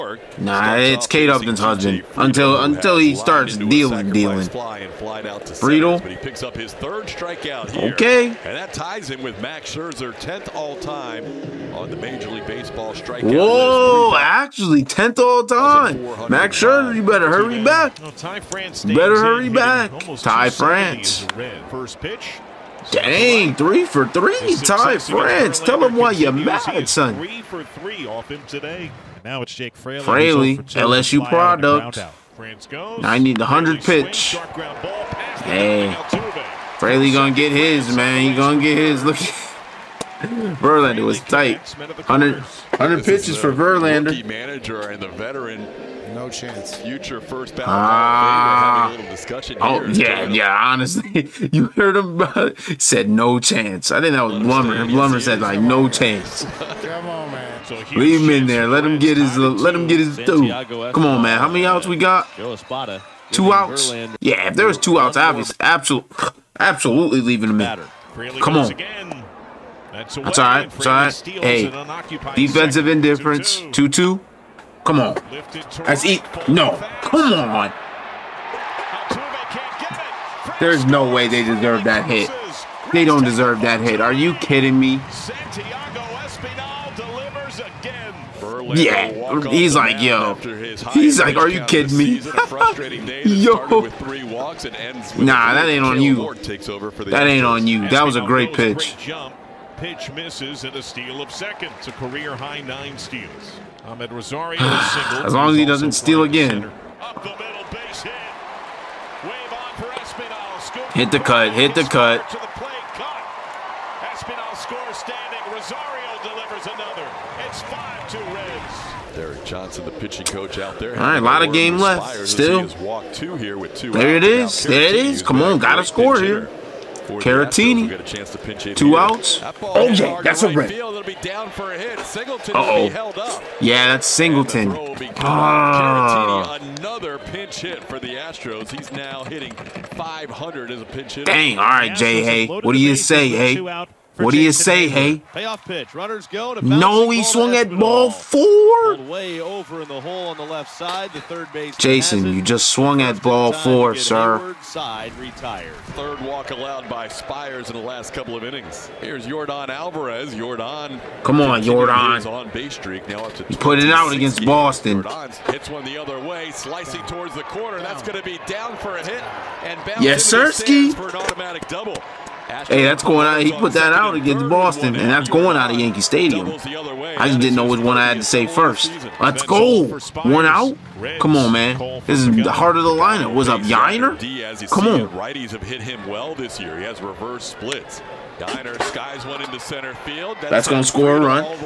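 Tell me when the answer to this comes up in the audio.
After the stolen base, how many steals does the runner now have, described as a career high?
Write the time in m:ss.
1:42.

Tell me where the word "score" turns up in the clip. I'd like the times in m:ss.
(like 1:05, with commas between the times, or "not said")
1:54, 2:05, 3:10.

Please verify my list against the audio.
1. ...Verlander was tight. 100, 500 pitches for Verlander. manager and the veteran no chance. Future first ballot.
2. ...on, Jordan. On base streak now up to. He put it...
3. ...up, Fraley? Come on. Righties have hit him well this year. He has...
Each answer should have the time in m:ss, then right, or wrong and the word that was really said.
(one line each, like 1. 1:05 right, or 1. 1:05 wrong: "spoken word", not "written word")
1. 0:40 wrong: "100", not "500"
2. 2:41 right
3. 3:03 wrong: "Yainer", not "Fraley".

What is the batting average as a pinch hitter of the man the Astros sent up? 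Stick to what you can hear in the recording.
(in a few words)
500.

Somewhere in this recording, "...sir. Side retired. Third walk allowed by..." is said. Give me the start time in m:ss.
2:33.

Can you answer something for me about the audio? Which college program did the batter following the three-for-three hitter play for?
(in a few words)
LSU.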